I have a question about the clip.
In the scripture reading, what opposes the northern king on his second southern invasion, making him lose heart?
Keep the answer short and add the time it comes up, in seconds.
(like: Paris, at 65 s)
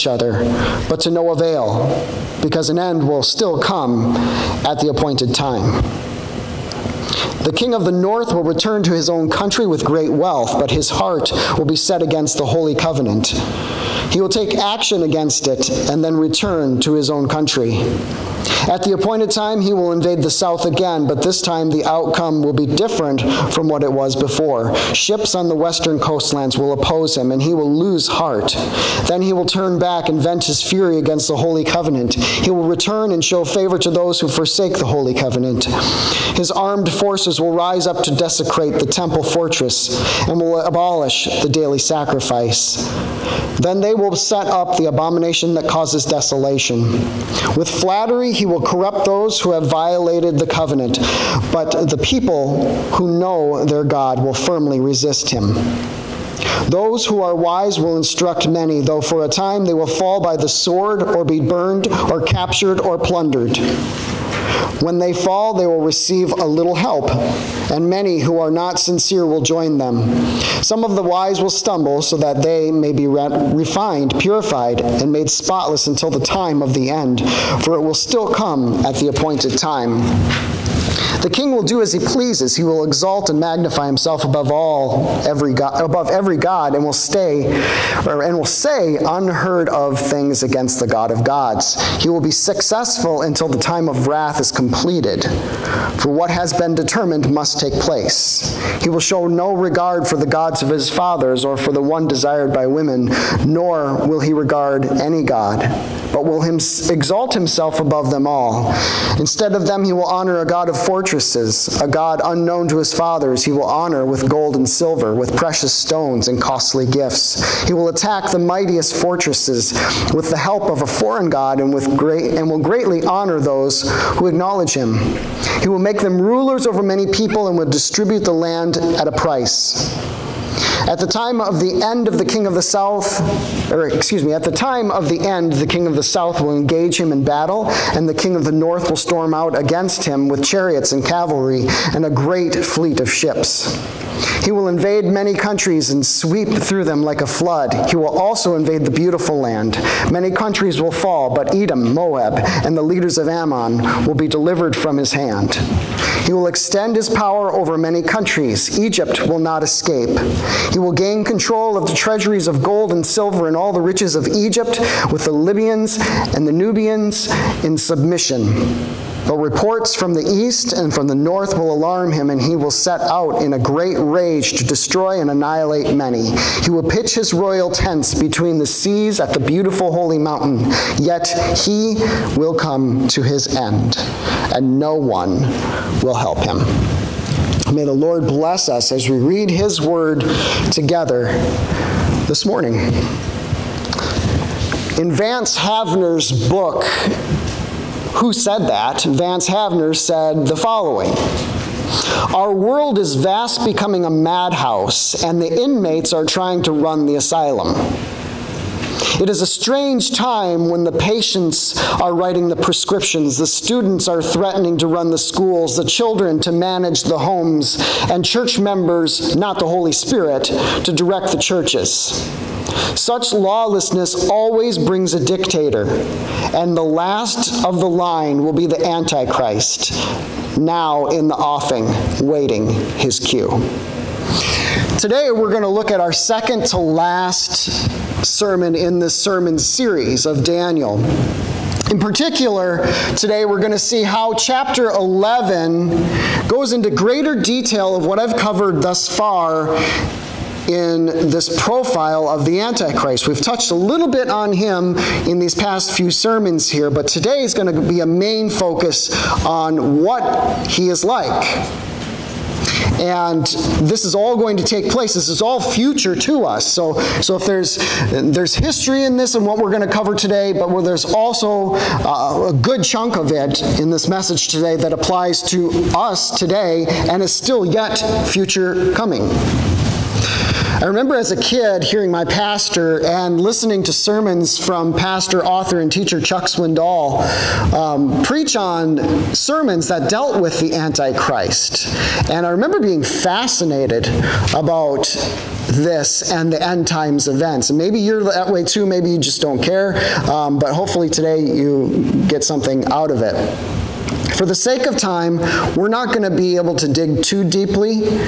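Ships on the western coastlands, at 24 s.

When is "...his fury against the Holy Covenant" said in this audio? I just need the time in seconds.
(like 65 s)
30 s.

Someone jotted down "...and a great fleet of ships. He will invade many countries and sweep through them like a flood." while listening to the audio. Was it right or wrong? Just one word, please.
right.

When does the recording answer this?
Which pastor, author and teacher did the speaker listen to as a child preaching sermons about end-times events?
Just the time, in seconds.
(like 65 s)
286 s.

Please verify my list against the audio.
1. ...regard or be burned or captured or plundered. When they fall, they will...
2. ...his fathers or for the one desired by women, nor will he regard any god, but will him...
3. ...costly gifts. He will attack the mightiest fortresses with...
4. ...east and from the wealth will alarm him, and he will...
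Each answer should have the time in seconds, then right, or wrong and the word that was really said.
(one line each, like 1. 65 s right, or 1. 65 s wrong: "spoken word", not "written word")
1. 60 s wrong: "sword", not "regard"
2. 100 s right
3. 116 s right
4. 170 s wrong: "north", not "wealth".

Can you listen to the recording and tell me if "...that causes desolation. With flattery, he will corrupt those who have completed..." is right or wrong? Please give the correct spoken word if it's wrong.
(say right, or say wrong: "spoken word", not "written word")
wrong: "violated", not "completed".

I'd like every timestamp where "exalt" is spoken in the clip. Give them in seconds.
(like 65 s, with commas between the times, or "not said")
82 s, 106 s.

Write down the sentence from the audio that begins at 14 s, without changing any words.
He will take action against it and then return to his own country.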